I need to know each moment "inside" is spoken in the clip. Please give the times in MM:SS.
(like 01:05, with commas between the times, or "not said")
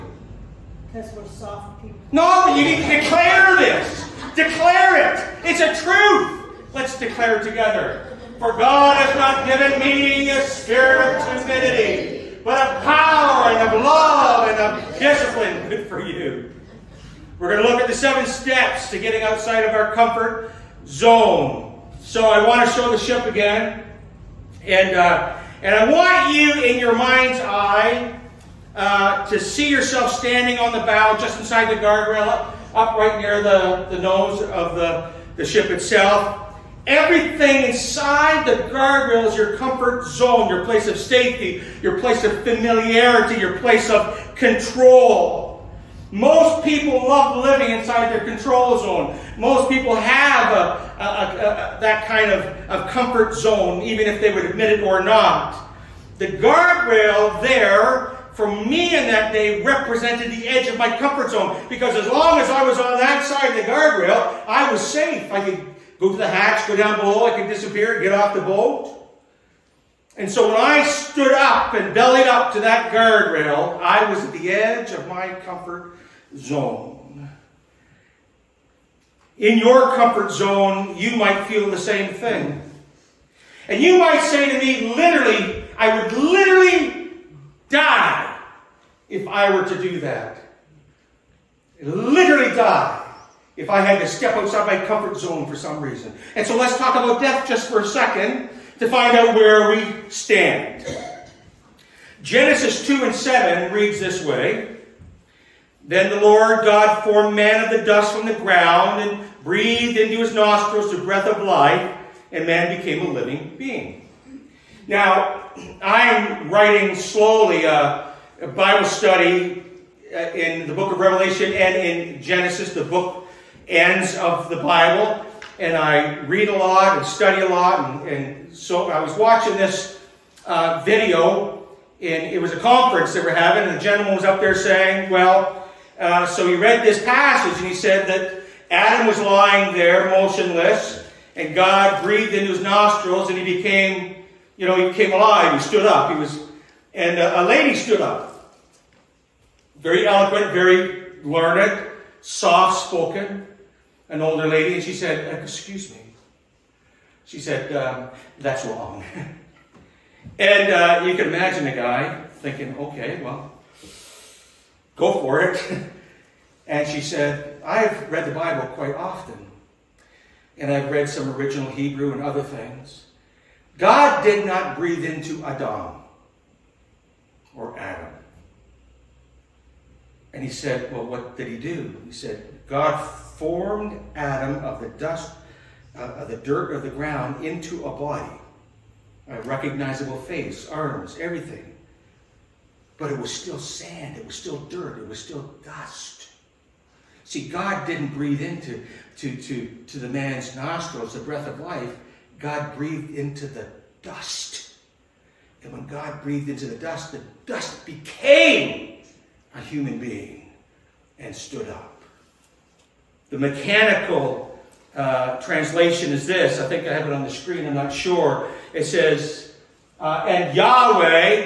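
00:31, 00:37, 00:47.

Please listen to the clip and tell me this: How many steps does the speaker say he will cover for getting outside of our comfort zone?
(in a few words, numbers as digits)
7.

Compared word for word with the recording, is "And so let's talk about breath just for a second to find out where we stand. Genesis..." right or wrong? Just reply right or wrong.
wrong.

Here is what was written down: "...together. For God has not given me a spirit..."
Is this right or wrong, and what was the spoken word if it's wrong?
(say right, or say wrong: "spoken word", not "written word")
right.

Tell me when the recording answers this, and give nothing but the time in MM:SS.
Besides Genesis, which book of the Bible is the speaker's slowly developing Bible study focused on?
02:00.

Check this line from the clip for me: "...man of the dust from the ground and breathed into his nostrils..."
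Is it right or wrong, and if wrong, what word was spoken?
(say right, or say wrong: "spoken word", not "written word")
right.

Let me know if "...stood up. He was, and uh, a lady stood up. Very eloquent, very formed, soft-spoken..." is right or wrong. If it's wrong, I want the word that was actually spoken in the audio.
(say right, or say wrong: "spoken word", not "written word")
wrong: "learned", not "formed".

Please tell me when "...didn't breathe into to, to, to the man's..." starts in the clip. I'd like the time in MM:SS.
03:17.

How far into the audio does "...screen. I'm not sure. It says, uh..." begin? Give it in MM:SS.
03:37.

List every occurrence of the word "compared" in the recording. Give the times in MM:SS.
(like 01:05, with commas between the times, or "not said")
not said.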